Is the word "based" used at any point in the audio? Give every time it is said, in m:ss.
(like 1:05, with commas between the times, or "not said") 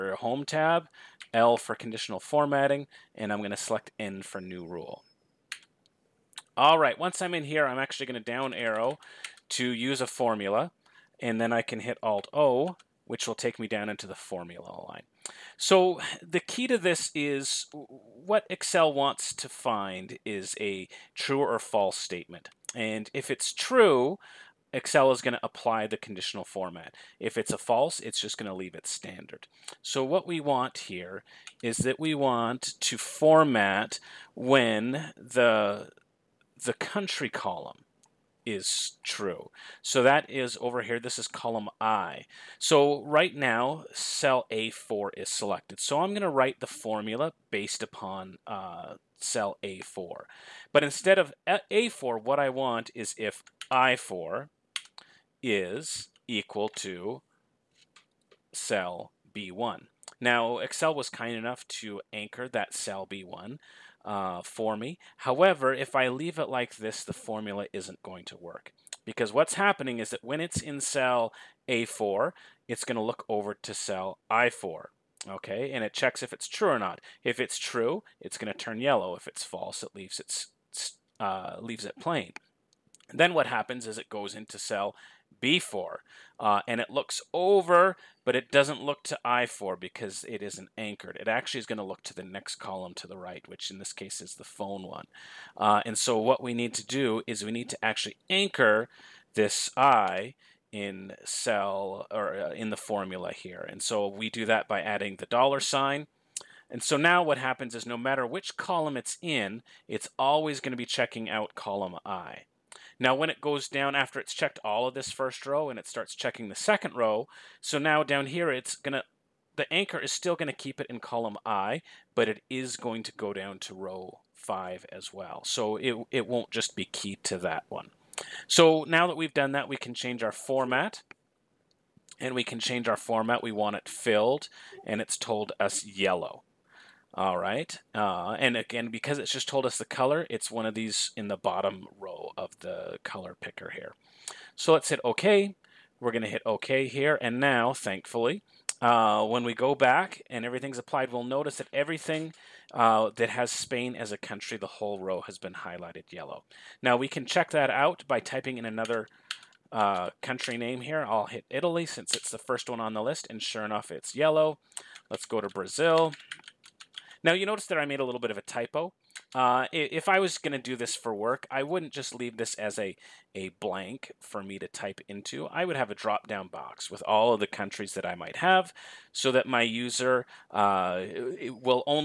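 0:47.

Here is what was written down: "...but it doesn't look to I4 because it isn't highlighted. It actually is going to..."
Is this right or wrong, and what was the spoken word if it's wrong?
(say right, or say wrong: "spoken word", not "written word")
wrong: "anchored", not "highlighted".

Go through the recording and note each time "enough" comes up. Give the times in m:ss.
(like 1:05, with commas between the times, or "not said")
1:01, 2:43.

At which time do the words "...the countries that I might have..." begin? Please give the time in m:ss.
2:57.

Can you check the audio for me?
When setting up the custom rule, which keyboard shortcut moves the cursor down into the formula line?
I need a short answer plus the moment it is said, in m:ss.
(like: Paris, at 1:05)
Alt-O, at 0:12.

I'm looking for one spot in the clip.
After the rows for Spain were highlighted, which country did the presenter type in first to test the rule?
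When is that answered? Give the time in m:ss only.
2:41.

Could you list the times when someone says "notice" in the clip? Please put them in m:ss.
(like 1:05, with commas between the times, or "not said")
2:31, 2:47.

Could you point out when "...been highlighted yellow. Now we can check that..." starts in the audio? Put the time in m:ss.
2:35.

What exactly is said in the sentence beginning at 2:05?
So it, it won't just be keyed to that one.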